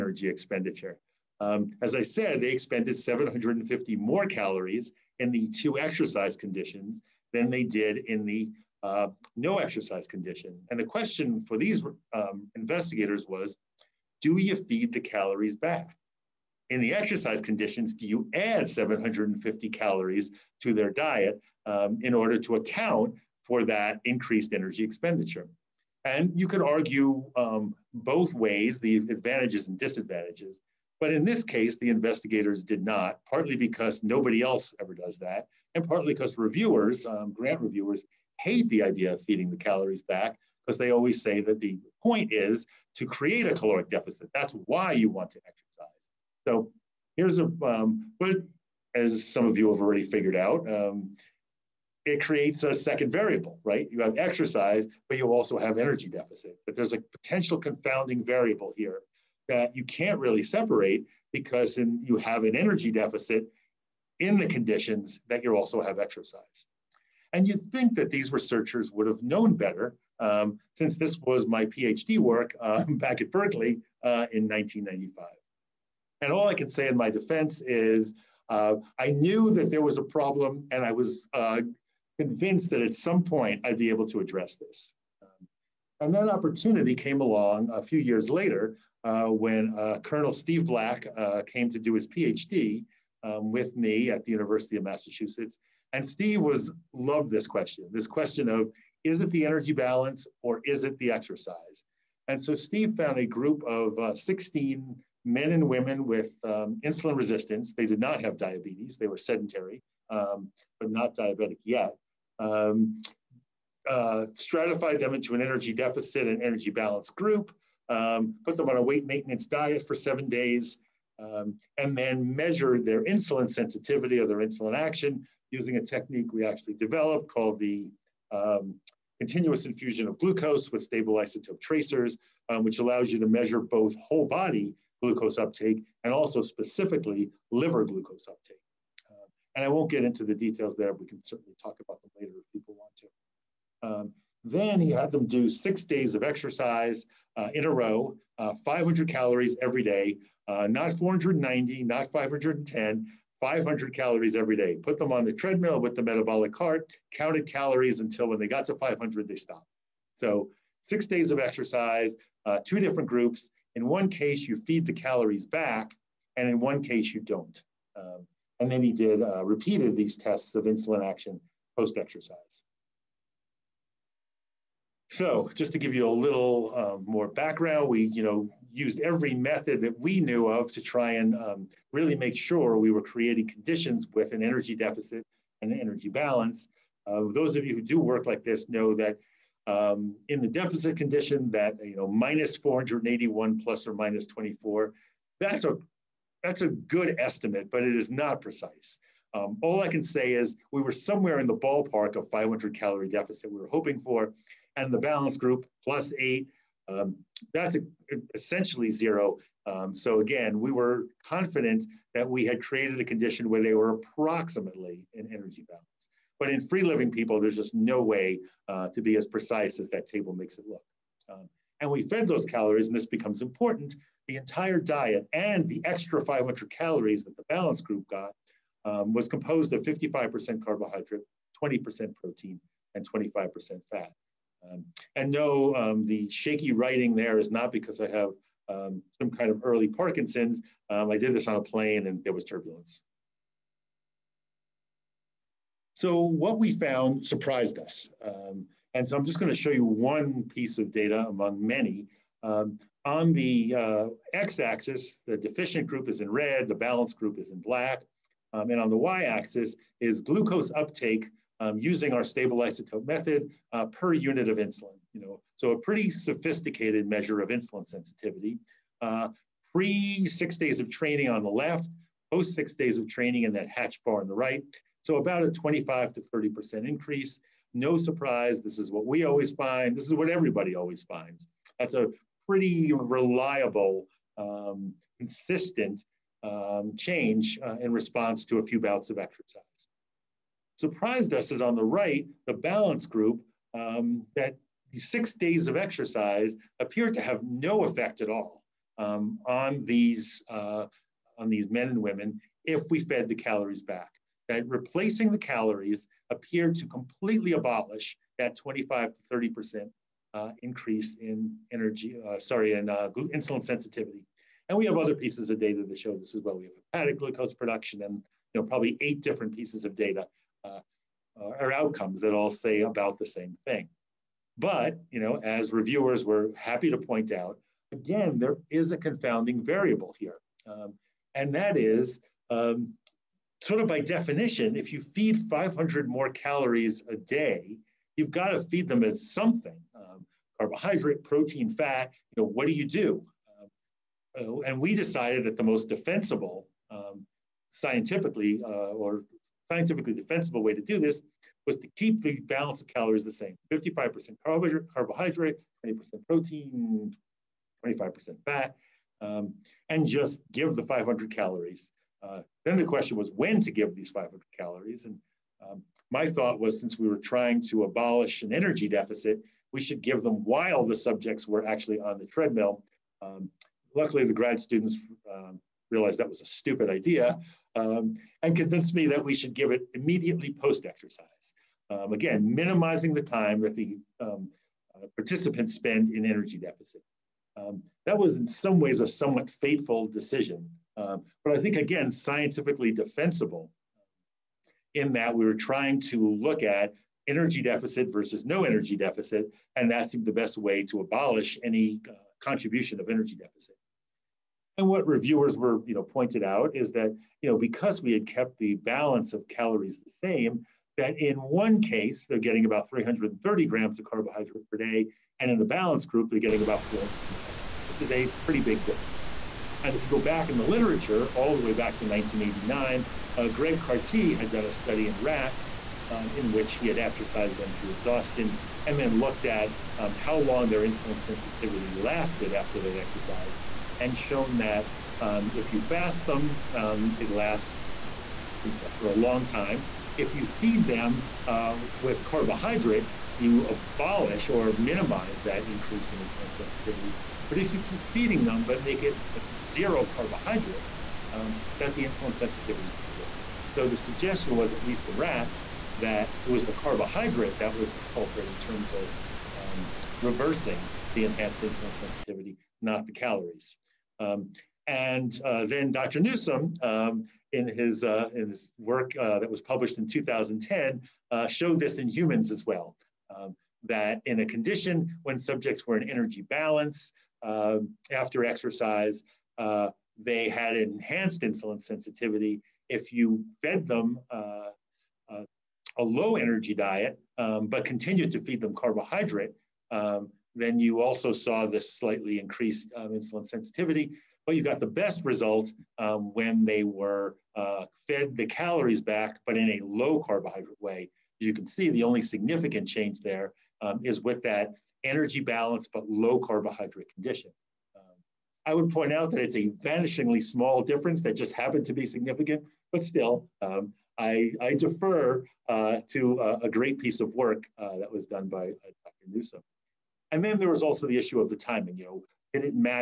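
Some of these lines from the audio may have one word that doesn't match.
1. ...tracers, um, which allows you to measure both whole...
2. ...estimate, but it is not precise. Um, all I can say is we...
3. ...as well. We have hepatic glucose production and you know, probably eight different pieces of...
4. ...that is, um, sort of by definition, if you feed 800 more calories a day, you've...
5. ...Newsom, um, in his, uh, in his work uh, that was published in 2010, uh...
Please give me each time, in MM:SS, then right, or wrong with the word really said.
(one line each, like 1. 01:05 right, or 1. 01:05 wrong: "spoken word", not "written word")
1. 02:11 right
2. 03:17 right
3. 05:16 right
4. 05:31 wrong: "500", not "800"
5. 07:46 right.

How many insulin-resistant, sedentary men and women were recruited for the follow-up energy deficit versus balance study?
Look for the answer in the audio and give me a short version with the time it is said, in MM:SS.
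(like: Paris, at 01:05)
16, at 01:44.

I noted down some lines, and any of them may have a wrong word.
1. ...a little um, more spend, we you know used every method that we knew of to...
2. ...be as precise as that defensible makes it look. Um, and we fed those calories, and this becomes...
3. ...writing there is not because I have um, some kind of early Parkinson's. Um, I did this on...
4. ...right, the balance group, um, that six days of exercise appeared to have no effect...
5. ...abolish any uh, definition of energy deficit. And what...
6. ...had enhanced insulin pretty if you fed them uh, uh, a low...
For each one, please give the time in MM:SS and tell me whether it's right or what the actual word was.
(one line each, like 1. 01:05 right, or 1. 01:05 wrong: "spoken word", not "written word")
1. 02:56 wrong: "background", not "spend"
2. 03:39 wrong: "table", not "defensible"
3. 03:56 right
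4. 04:51 right
5. 06:41 wrong: "contribution", not "definition"
6. 08:00 wrong: "sensitivity", not "pretty".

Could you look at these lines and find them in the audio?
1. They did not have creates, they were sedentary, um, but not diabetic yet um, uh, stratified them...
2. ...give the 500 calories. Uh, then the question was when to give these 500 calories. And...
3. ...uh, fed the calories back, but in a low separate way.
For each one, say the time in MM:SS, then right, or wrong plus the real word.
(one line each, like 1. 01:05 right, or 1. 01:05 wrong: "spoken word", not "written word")
1. 01:47 wrong: "diabetes", not "creates"
2. 06:00 right
3. 08:17 wrong: "carbohydrate", not "separate".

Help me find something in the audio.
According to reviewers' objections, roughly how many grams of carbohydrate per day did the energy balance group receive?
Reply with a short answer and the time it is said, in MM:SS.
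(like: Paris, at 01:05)
410, at 06:56.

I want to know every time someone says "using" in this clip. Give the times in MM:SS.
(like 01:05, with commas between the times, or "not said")
02:05, 04:21.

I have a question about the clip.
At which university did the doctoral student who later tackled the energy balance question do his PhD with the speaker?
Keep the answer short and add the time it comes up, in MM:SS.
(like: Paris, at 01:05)
University of Massachusetts, at 01:34.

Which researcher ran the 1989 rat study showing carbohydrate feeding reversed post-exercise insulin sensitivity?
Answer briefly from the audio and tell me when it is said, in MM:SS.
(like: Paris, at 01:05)
Greg Cartee, at 07:03.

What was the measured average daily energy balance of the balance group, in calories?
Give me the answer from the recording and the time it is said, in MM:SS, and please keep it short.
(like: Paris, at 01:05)
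plus 8, at 03:25.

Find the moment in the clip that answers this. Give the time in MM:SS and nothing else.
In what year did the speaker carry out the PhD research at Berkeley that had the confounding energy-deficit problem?
01:14.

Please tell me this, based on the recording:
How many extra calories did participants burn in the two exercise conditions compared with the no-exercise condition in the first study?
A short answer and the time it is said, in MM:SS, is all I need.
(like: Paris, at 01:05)
750, at 00:02.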